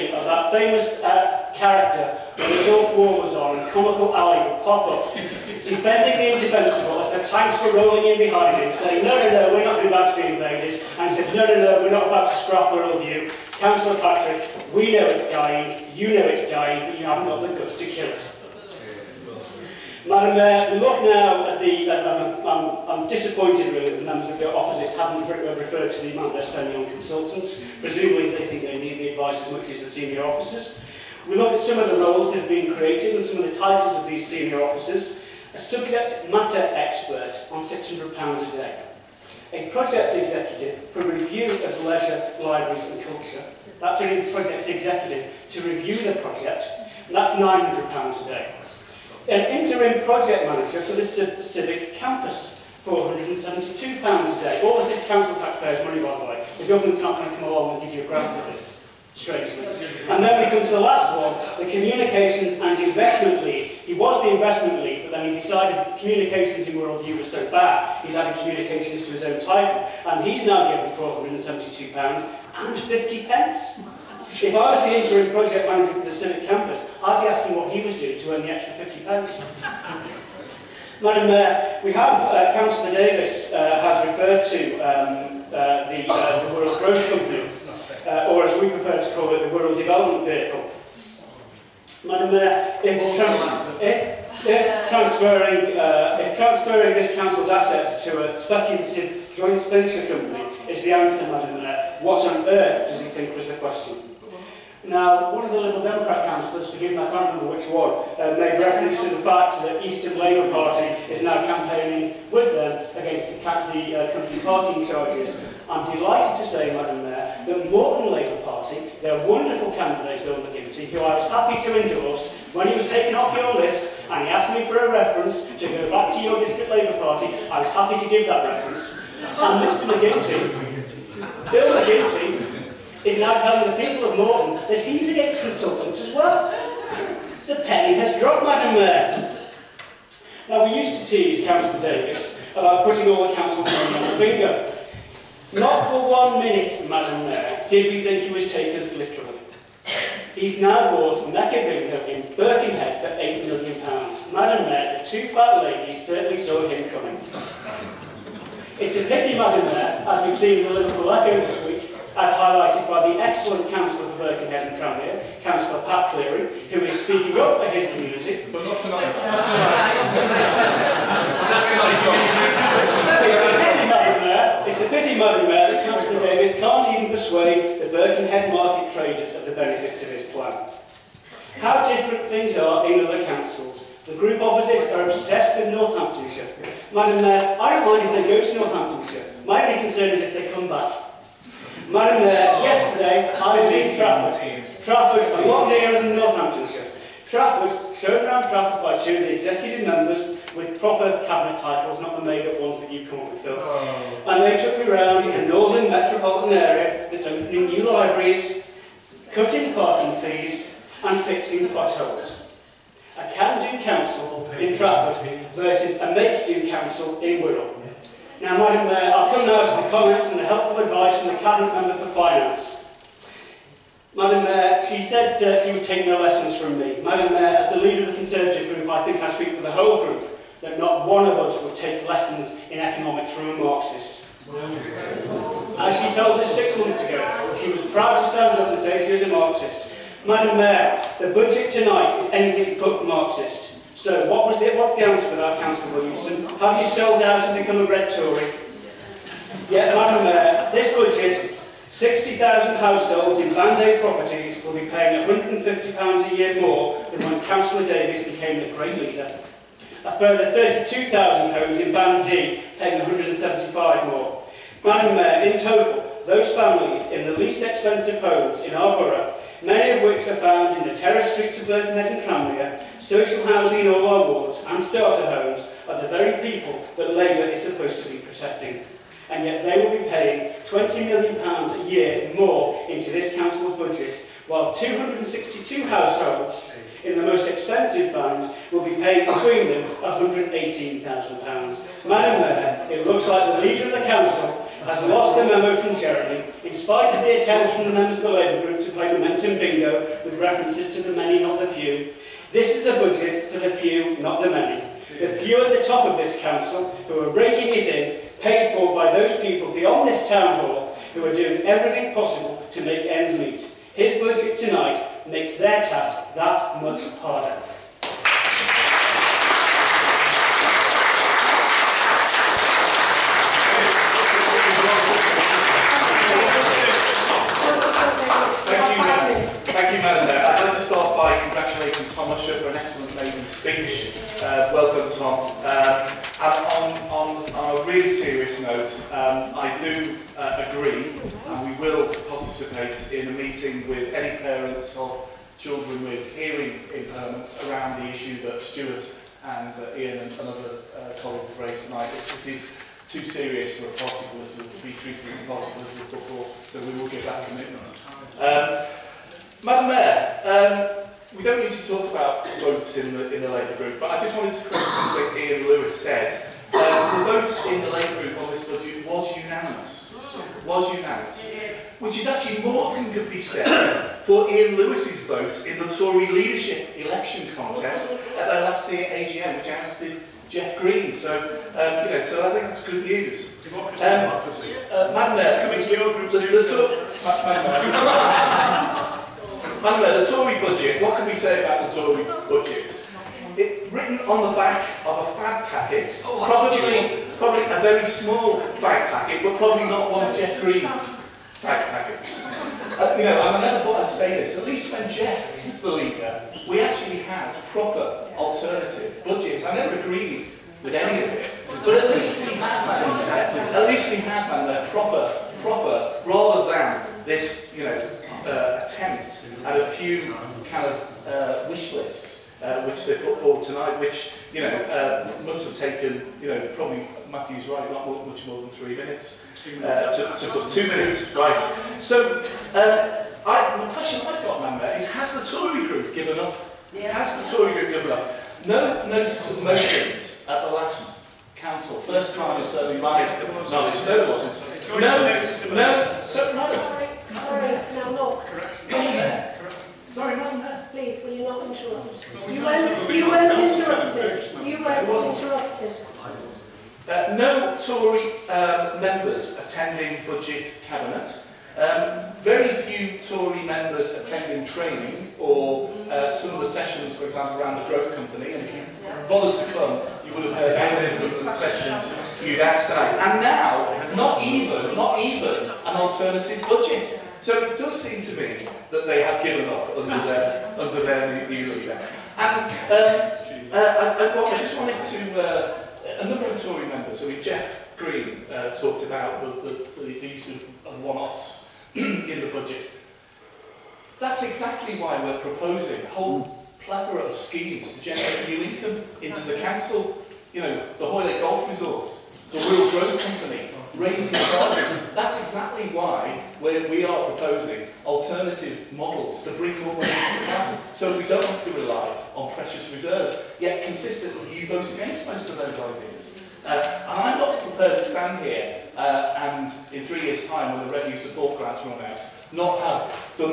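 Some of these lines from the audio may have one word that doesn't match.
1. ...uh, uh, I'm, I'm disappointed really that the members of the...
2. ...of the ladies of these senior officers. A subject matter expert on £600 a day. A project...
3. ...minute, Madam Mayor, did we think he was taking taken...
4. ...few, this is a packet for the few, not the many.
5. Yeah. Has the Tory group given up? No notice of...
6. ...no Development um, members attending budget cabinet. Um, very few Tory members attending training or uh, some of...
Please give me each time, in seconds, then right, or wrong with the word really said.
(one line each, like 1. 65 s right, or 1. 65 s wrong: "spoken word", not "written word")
1. 22 s right
2. 33 s wrong: "titles", not "ladies"
3. 146 s right
4. 301 s wrong: "budget", not "packet"
5. 436 s right
6. 457 s wrong: "Tory", not "Development".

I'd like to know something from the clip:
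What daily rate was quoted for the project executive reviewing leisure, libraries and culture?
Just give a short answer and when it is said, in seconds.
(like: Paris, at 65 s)
£900 a day, at 47 s.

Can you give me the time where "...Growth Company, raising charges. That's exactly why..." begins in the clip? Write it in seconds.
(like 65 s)
502 s.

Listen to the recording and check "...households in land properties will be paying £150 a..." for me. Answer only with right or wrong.
right.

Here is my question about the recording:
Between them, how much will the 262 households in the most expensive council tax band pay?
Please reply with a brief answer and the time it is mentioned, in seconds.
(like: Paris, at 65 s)
£118,000, at 289 s.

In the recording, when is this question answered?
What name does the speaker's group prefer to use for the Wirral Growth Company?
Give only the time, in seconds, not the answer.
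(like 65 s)
89 s.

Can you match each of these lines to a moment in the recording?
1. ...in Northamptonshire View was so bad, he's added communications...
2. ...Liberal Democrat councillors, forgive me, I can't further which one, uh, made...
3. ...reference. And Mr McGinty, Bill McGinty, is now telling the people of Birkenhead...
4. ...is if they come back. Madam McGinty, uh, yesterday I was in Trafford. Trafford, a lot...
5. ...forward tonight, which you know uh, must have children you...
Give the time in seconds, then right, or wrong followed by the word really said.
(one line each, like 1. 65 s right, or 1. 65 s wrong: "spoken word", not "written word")
1. 66 s wrong: "Wirral", not "Northamptonshire"
2. 105 s wrong: "remember", not "further"
3. 128 s wrong: "Moreton", not "Birkenhead"
4. 190 s wrong: "Mayor", not "McGinty"
5. 423 s wrong: "taken", not "children".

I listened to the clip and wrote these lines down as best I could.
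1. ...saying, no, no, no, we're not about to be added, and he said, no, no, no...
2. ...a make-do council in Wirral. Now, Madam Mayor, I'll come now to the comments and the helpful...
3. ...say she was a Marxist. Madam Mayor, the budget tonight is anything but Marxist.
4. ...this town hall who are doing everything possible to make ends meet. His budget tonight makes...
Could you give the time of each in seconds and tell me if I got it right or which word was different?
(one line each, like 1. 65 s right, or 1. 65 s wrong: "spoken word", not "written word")
1. 8 s wrong: "invaded", not "added"
2. 215 s right
3. 238 s right
4. 310 s right.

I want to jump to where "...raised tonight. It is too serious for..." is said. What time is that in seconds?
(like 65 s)
351 s.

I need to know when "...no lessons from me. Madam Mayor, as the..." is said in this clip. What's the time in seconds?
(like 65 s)
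226 s.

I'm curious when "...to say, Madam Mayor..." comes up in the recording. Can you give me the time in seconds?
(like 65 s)
116 s.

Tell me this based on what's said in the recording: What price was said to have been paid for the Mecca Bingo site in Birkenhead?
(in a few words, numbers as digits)
£8 million.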